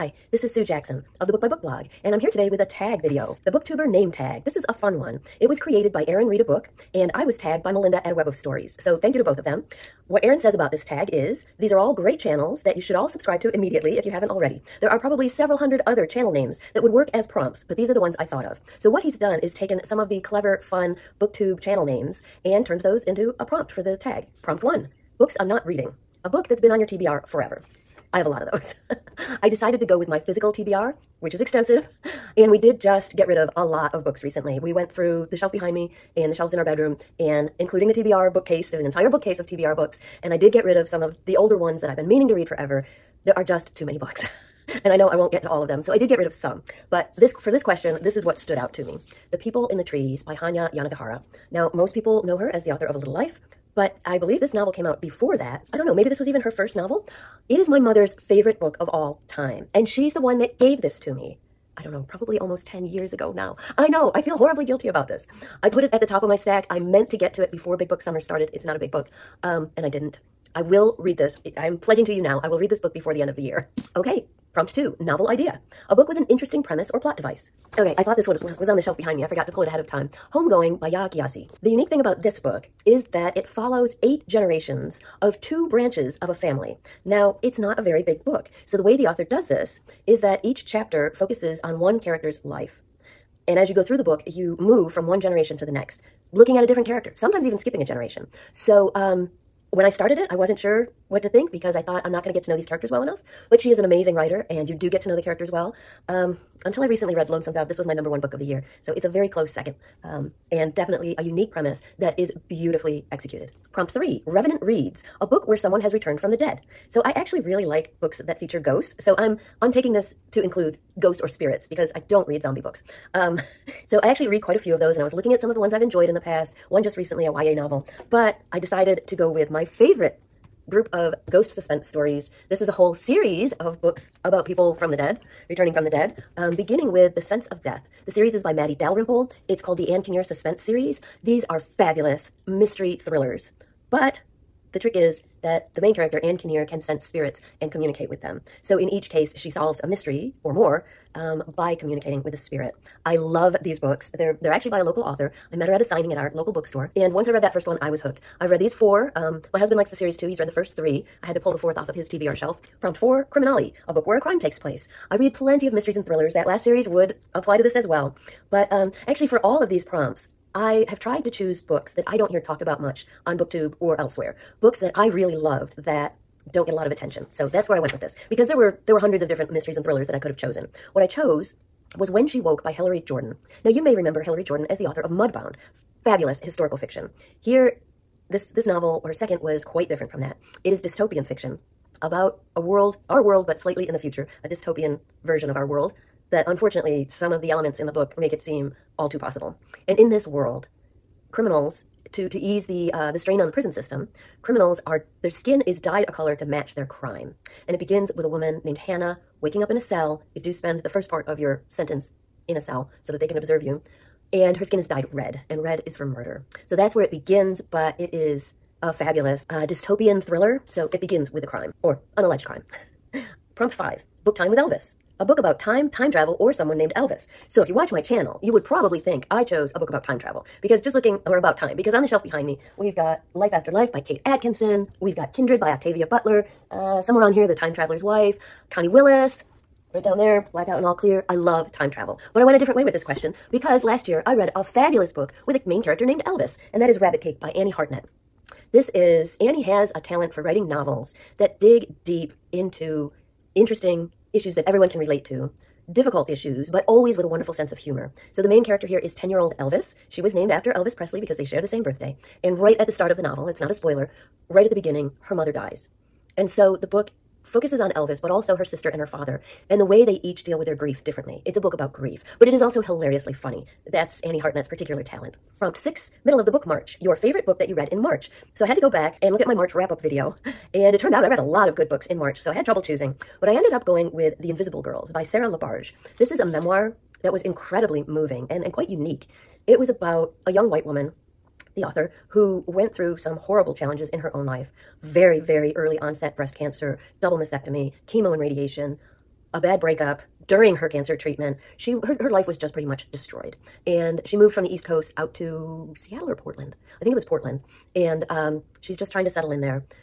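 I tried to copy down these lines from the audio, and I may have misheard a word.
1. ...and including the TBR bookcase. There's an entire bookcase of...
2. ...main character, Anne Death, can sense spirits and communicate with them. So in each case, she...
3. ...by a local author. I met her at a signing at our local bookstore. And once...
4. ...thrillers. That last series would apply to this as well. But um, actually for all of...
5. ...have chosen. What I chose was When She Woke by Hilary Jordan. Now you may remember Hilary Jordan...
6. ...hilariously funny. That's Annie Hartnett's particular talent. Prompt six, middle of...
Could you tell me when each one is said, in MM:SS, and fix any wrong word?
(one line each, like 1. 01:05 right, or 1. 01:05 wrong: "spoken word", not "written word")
1. 00:37 right
2. 02:25 wrong: "Kinnear", not "Death"
3. 02:34 right
4. 02:46 right
5. 03:00 right
6. 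04:32 right.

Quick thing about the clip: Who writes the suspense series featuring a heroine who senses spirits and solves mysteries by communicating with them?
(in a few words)
Matty Dalrymple.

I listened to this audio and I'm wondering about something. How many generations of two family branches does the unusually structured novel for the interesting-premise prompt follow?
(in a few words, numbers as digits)
8.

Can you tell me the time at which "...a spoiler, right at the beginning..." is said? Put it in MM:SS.
04:23.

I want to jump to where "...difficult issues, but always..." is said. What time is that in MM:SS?
04:15.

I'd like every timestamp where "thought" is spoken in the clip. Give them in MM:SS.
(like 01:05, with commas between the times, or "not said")
00:18, 01:18, 01:41.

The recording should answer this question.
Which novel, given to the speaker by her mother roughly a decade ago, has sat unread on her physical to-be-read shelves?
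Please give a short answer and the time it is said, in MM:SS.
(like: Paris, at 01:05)
The People in the Trees, at 00:49.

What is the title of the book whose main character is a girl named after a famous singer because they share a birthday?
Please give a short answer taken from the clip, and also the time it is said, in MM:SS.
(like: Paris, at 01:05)
Rabbit Cake, at 04:06.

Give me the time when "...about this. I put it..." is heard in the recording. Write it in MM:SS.
01:04.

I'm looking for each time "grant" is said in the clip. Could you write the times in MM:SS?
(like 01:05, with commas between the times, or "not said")
not said.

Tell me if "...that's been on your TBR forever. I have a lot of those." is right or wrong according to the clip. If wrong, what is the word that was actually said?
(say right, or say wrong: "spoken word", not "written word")
right.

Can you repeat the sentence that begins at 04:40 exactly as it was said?
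And it turned out I read a lot of good books in March, so I had trouble choosing.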